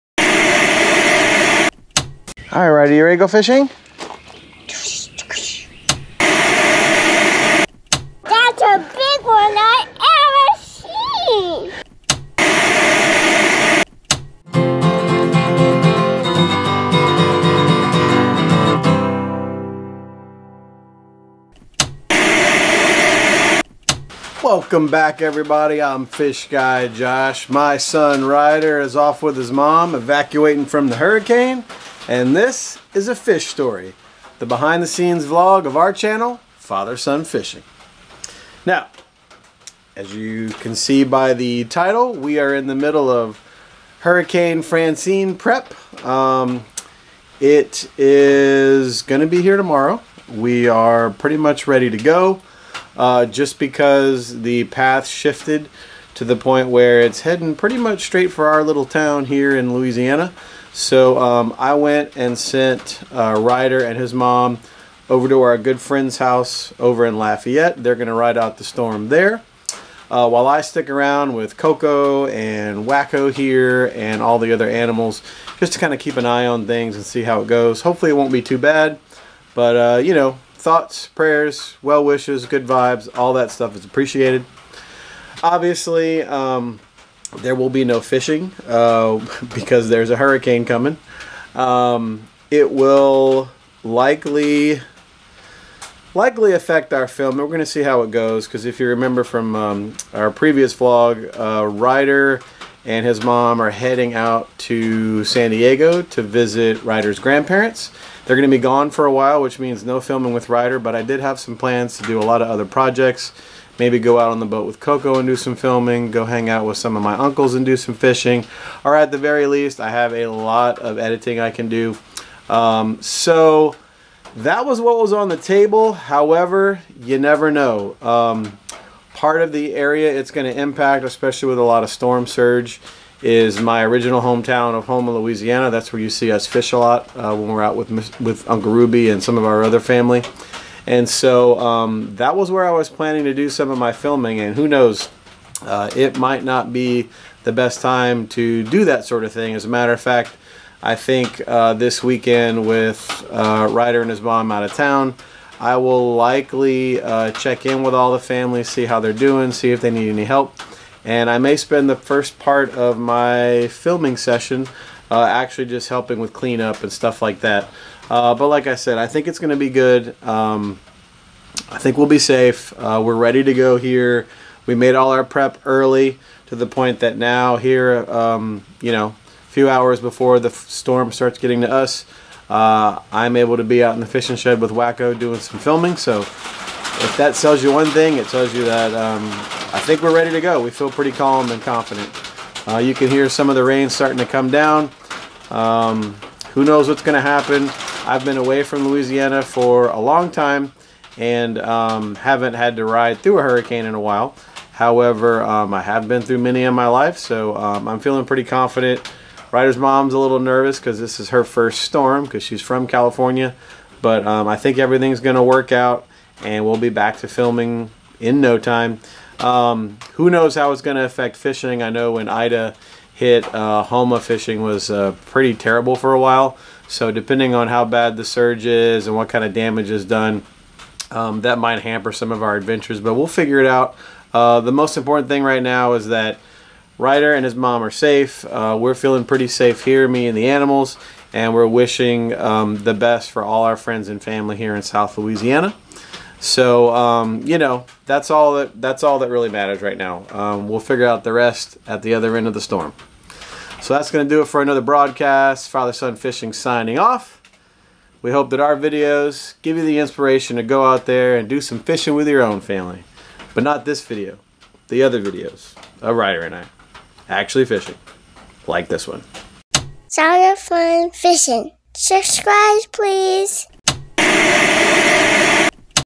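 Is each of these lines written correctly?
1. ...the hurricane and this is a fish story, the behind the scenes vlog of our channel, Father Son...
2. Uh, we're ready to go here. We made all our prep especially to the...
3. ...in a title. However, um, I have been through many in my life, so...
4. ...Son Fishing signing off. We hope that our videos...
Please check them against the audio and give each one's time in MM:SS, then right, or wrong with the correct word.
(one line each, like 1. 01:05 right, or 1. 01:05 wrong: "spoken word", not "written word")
1. 00:30 right
2. 02:52 wrong: "early", not "especially"
3. 03:23 wrong: "while", not "title"
4. 04:15 right.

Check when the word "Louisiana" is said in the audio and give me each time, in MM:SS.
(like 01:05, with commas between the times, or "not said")
00:59, 02:15, 03:18, 04:05.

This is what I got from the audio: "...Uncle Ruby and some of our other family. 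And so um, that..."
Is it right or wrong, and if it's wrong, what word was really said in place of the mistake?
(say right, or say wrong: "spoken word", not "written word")
right.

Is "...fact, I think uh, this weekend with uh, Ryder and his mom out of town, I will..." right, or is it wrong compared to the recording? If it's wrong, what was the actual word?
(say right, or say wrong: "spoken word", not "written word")
right.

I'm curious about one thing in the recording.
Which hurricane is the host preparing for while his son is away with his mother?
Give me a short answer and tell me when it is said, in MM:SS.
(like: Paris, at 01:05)
Hurricane Francine, at 00:43.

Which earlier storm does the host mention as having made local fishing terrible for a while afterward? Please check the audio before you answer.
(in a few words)
Ida.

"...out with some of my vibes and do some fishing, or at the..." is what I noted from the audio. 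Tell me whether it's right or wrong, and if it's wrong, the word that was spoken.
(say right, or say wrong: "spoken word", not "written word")
wrong: "uncles", not "vibes".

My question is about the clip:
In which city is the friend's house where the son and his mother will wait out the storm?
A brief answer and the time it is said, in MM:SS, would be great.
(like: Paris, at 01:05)
Lafayette, at 01:07.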